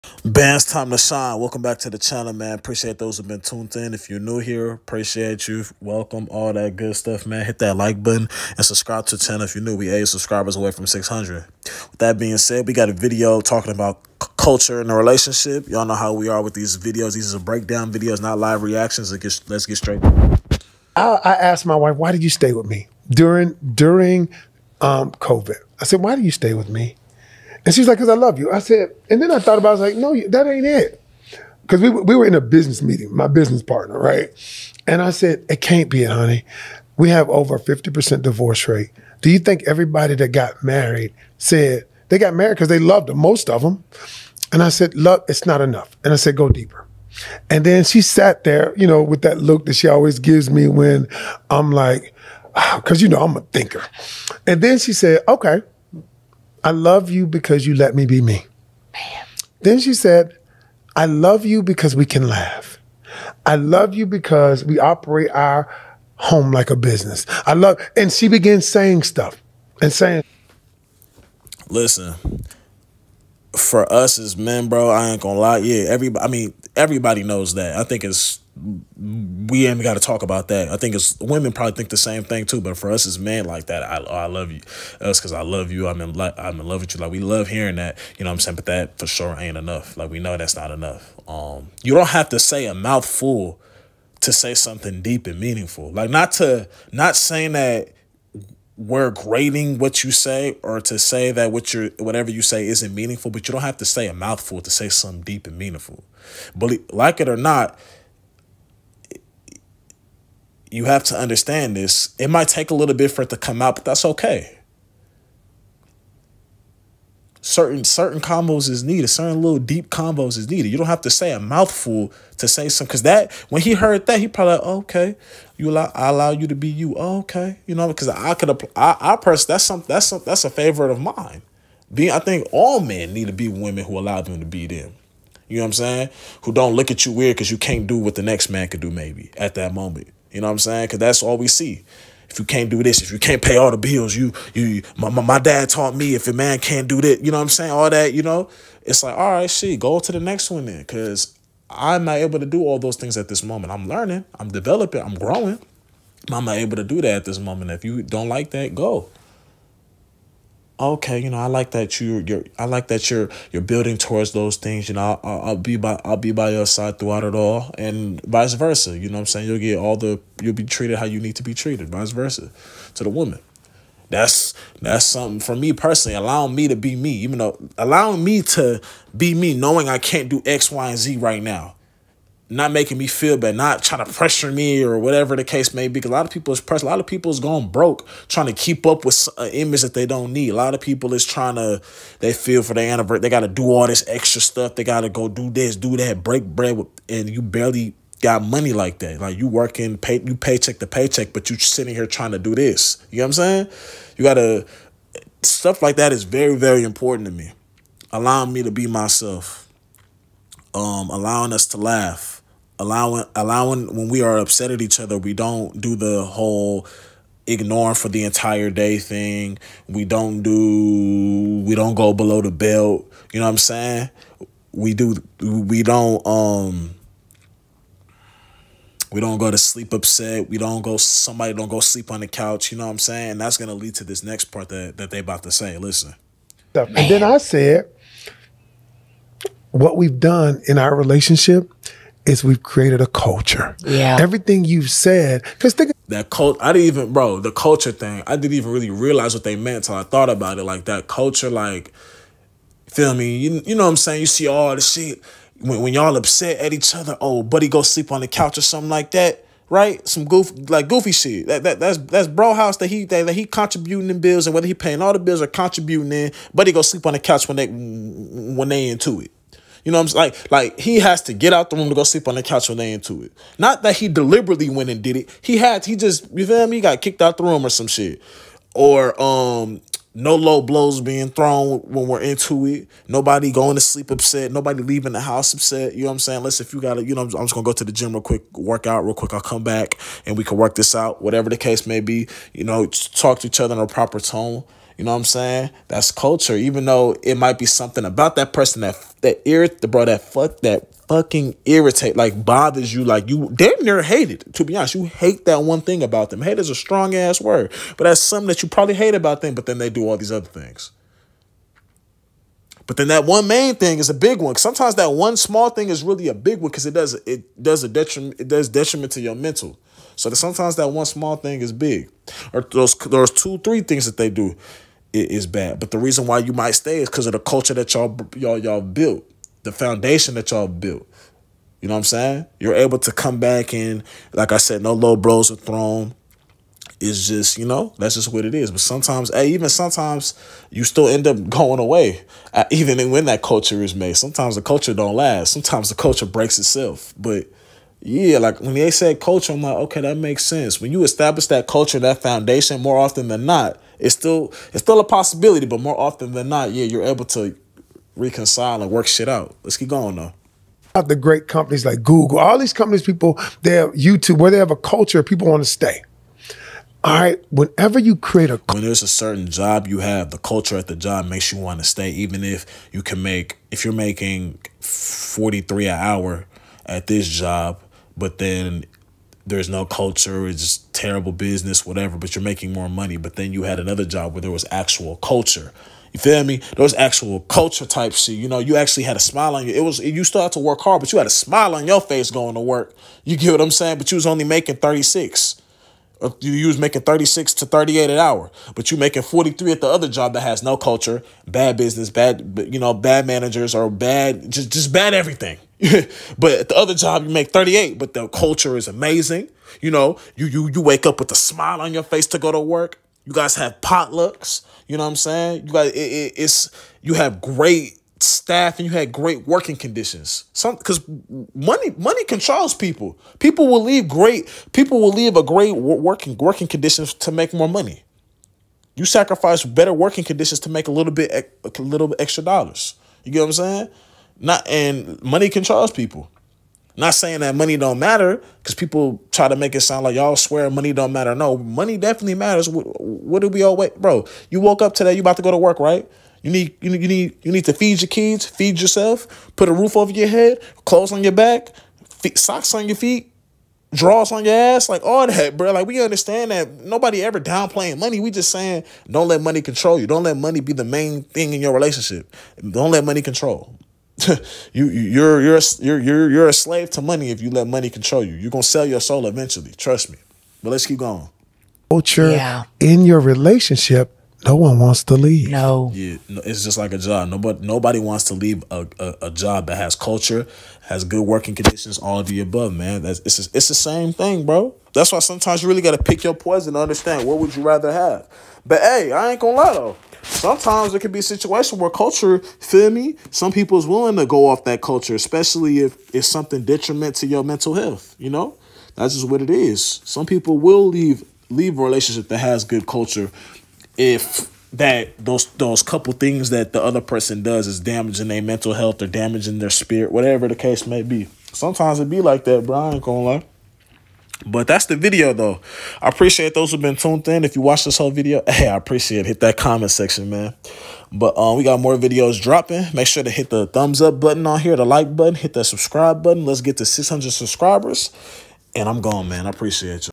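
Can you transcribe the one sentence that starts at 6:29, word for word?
It was you still had to work hard, but you had a smile on your face going to work.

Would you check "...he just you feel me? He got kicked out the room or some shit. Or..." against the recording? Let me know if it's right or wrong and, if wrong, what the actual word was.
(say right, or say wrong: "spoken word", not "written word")
right.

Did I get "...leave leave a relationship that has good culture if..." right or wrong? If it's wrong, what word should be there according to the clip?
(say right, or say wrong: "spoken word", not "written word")
right.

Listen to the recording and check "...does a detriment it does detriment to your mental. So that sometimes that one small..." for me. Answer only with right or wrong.
right.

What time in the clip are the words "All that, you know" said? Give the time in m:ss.
2:27.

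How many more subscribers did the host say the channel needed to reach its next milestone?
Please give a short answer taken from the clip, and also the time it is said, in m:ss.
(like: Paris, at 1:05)
8, at 0:09.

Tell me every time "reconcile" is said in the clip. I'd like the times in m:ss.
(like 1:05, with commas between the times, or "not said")
5:58.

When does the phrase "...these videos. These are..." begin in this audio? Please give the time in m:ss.
0:16.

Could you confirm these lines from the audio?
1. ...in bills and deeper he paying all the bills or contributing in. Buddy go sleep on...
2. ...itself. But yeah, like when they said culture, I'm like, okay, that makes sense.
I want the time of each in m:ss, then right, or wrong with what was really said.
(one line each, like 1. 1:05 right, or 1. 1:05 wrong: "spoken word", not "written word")
1. 4:24 wrong: "whether", not "deeper"
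2. 5:46 right.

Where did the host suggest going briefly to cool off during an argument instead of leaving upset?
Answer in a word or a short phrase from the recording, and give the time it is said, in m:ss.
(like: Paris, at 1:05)
The gym, at 4:47.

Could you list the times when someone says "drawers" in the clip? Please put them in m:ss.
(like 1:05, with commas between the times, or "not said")
7:33.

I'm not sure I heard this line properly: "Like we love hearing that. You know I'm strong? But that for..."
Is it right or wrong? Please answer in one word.
wrong.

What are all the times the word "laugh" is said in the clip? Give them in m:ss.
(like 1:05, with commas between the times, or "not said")
1:02, 3:31.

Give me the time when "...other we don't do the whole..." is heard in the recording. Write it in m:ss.
3:34.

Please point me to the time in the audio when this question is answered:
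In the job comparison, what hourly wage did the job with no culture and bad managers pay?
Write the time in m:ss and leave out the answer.
6:14.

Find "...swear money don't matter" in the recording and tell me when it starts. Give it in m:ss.
7:20.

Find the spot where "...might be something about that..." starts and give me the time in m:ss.
4:57.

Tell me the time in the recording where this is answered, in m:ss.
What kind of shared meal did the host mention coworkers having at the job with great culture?
6:53.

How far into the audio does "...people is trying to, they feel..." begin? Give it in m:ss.
3:10.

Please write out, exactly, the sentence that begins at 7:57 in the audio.
Nobody nobody wants to leave a, a, a job that has culture, has good working conditions, all of the above, man.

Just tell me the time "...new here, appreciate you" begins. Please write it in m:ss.
0:04.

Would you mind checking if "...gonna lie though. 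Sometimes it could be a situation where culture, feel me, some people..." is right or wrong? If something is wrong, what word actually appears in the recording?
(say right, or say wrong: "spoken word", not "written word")
right.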